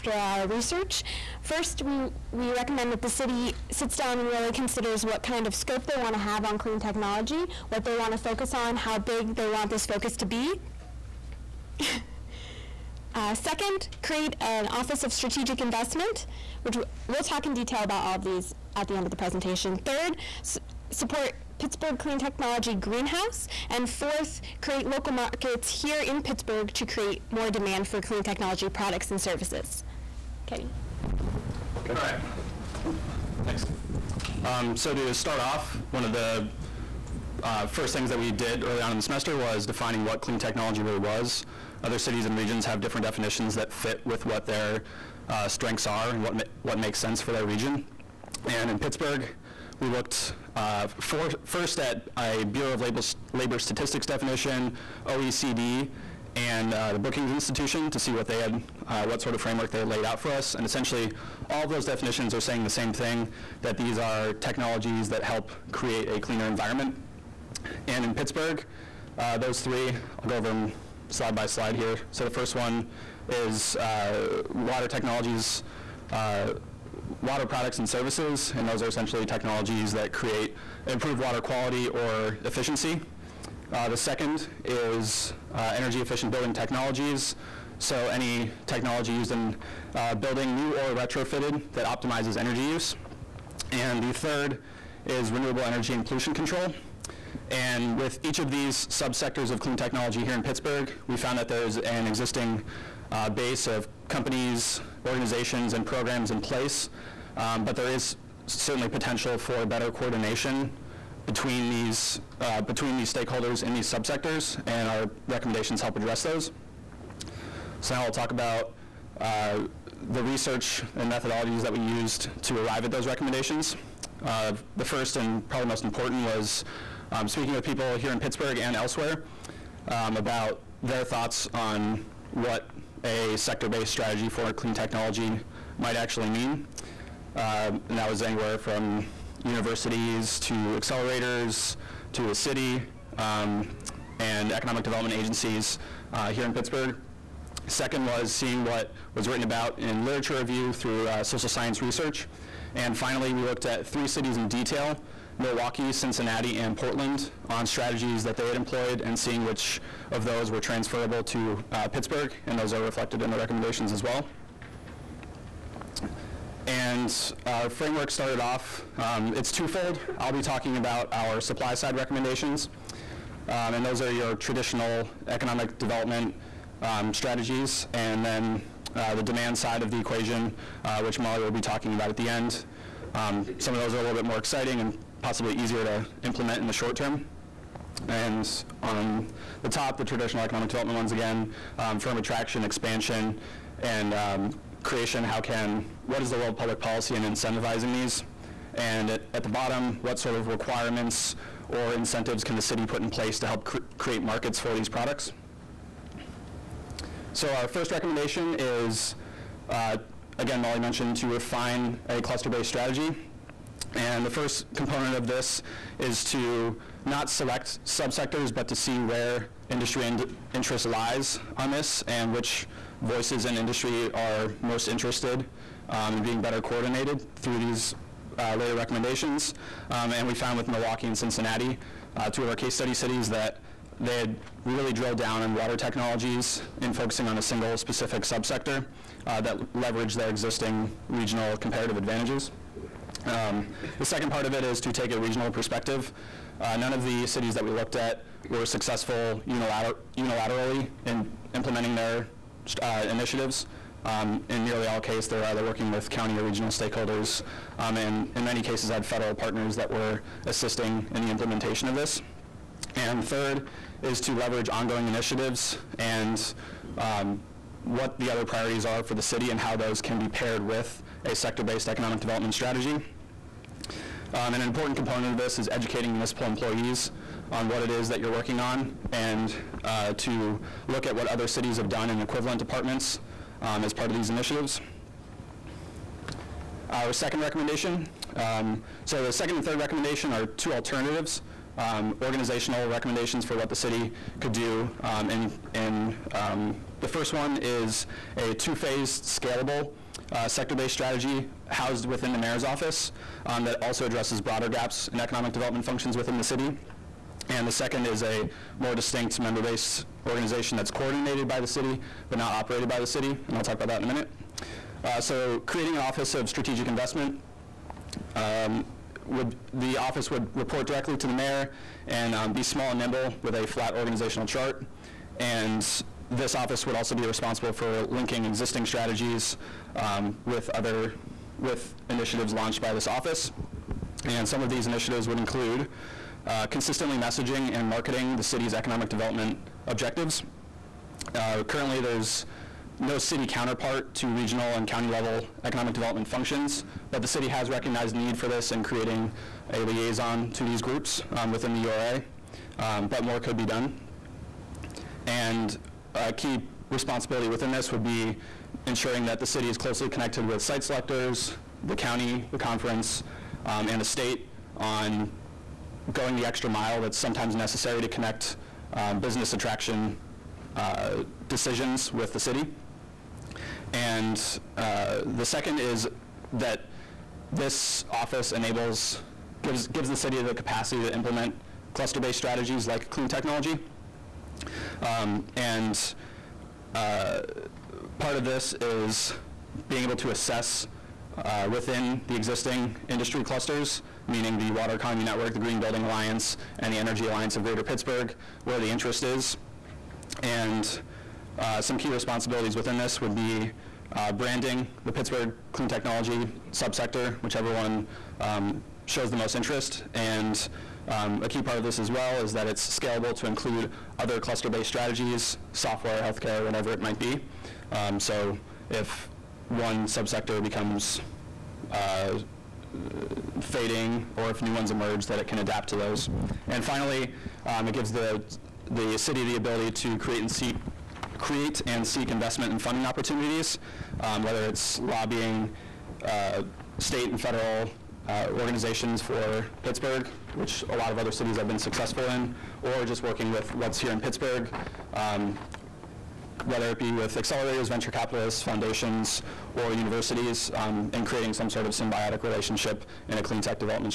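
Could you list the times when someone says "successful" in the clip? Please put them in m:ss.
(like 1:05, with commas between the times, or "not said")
4:08, 7:21.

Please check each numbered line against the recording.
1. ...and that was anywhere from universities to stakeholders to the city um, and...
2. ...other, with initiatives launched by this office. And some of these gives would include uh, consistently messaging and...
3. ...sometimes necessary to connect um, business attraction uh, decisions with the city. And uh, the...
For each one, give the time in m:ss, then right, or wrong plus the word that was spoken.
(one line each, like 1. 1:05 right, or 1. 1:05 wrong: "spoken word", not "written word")
1. 2:17 wrong: "accelerators", not "stakeholders"
2. 5:30 wrong: "initiatives", not "gives"
3. 6:07 right.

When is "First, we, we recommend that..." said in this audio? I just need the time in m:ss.
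0:01.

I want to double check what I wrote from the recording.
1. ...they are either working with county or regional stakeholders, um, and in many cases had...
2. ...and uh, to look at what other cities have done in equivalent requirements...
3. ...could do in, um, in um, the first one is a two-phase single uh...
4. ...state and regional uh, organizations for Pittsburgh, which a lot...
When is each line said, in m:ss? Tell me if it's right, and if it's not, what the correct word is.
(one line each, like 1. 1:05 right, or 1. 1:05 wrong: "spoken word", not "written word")
1. 4:15 right
2. 4:39 wrong: "departments", not "requirements"
3. 4:54 wrong: "scalable", not "single"
4. 7:16 wrong: "federal", not "regional".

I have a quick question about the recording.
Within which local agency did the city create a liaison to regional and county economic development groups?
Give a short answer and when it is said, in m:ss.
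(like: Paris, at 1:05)
URA, at 5:51.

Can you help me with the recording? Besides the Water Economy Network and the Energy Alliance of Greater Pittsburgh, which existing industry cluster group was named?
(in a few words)
Green Building Alliance.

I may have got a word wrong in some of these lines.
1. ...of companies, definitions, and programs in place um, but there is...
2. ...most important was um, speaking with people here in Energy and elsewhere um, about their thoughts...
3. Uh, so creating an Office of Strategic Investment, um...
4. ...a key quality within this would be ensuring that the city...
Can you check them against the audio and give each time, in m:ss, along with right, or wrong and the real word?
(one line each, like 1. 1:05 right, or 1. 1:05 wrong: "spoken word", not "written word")
1. 1:43 wrong: "organizations", not "definitions"
2. 2:05 wrong: "Pittsburgh", not "Energy"
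3. 5:15 right
4. 5:56 wrong: "responsibility", not "quality".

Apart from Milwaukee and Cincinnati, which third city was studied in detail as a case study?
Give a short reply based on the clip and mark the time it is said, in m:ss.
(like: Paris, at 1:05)
Portland, at 2:36.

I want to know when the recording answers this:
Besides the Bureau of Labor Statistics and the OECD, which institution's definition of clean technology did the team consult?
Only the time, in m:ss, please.
0:56.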